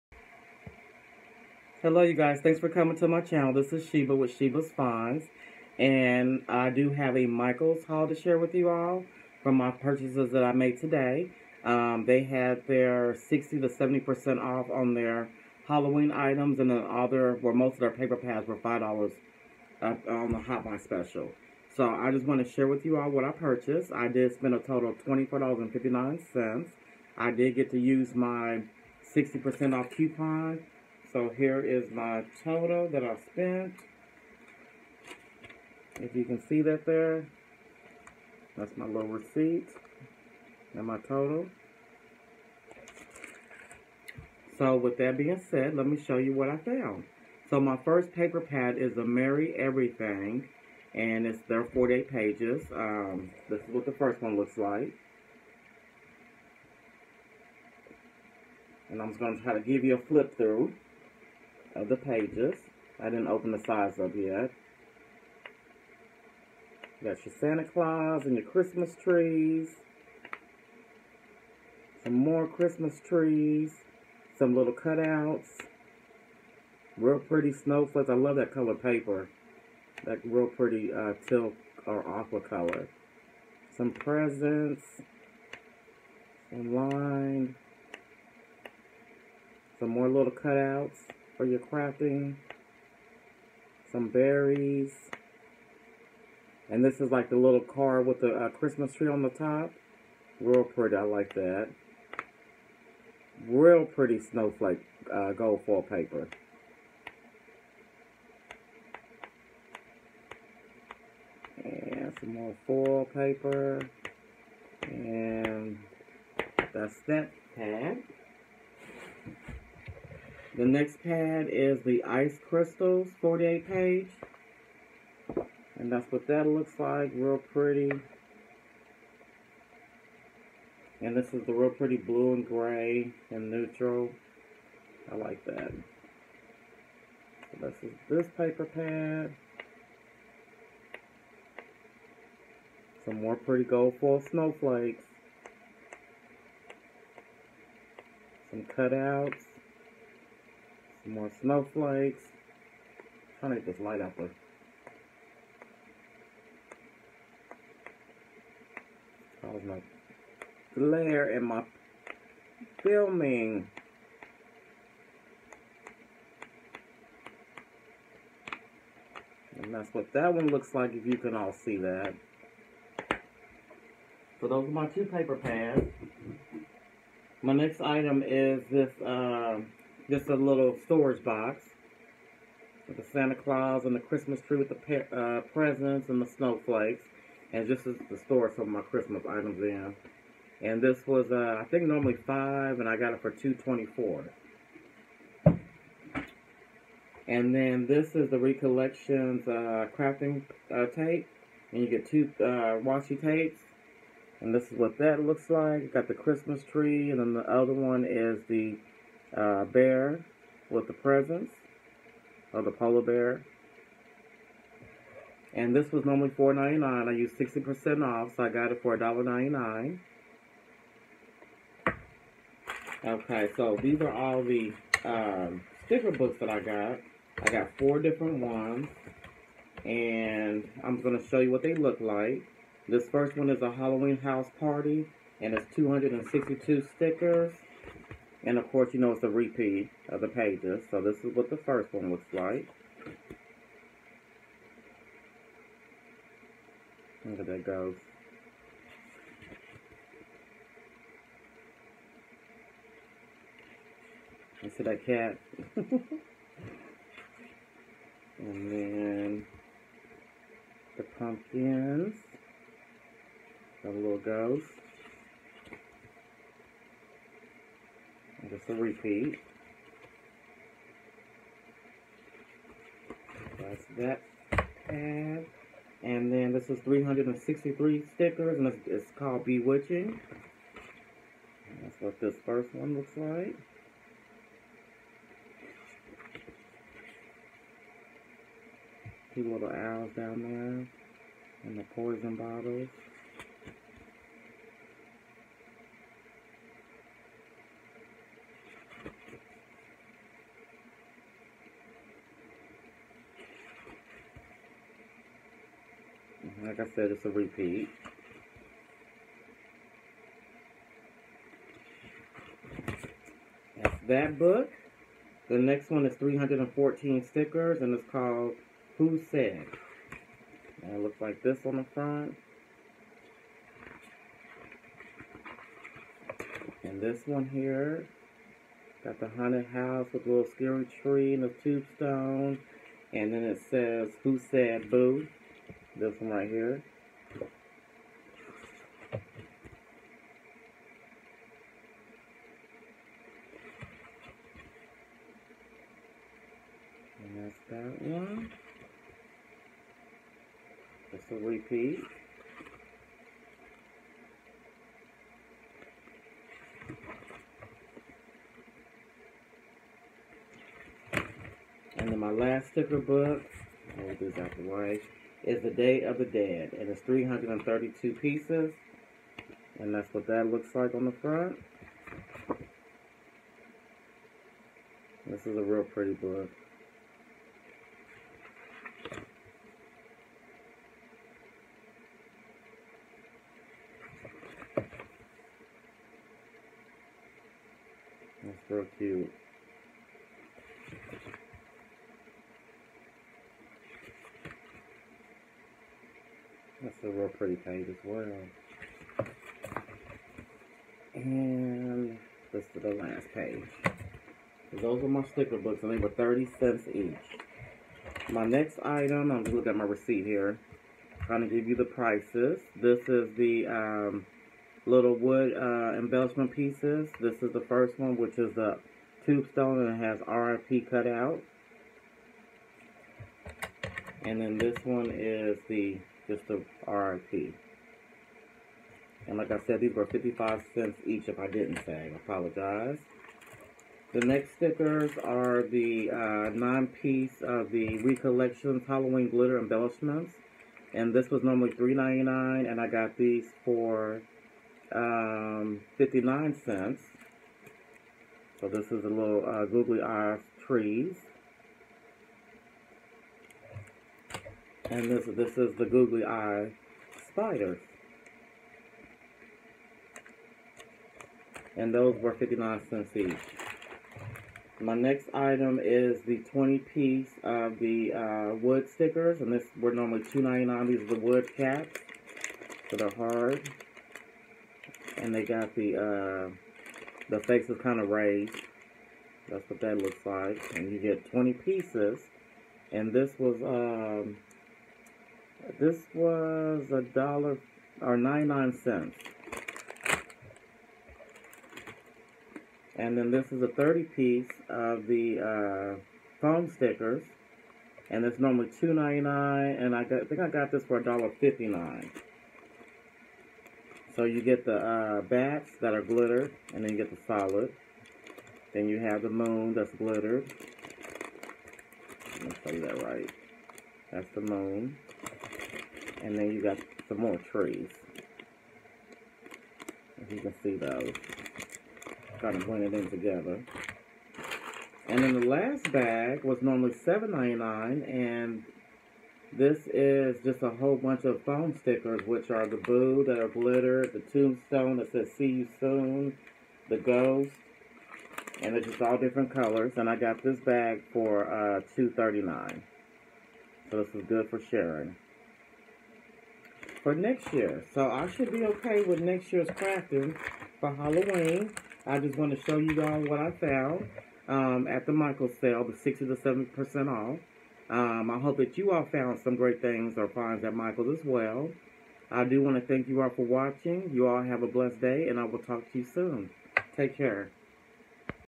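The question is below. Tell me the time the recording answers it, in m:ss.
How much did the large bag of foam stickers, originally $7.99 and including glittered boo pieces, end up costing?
9:01.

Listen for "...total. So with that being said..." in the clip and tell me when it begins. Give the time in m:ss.
0:40.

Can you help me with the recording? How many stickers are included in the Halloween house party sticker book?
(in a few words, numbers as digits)
262.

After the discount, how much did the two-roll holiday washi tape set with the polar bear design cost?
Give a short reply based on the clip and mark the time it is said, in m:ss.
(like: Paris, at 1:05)
$1.99, at 3:38.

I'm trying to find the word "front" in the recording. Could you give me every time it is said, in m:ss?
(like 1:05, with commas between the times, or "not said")
5:21, 6:11.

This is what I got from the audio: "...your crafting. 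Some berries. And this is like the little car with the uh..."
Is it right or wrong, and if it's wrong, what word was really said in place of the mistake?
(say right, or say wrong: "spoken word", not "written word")
right.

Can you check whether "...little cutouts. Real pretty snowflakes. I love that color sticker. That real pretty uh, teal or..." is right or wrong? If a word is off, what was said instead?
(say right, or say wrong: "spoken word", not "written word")
wrong: "paper", not "sticker".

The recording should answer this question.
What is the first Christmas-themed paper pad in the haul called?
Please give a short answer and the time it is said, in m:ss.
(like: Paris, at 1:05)
Merry Everything, at 0:49.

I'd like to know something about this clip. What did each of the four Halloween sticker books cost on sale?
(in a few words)
30 cents.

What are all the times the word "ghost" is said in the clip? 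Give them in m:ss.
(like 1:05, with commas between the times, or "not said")
4:24, 8:56.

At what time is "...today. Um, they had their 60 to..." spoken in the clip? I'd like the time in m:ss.
0:10.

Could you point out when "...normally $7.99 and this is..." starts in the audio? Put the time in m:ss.
8:46.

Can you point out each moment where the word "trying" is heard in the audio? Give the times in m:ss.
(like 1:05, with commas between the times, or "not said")
2:33, 6:51, 8:42.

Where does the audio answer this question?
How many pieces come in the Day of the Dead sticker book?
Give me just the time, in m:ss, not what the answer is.
6:07.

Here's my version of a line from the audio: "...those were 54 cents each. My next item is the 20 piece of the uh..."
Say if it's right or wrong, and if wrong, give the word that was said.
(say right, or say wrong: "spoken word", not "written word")
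wrong: "59", not "54".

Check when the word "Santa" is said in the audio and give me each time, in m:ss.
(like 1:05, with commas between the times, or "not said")
1:07, 3:03.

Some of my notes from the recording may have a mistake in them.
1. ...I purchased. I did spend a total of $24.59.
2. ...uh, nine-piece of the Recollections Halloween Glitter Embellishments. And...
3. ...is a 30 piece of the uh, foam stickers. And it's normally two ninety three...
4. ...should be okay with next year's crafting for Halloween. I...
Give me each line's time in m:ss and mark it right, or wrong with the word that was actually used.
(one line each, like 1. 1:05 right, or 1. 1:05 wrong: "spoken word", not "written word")
1. 0:23 right
2. 7:16 right
3. 8:13 wrong: "nine", not "three"
4. 9:08 right.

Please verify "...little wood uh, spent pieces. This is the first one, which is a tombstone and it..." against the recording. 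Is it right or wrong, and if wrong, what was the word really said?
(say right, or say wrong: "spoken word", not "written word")
wrong: "embellishment", not "spent".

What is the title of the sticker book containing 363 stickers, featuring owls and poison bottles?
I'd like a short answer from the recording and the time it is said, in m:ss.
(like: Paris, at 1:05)
Bewitching, at 4:39.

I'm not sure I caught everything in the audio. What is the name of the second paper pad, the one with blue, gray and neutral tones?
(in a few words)
Ice Crystals.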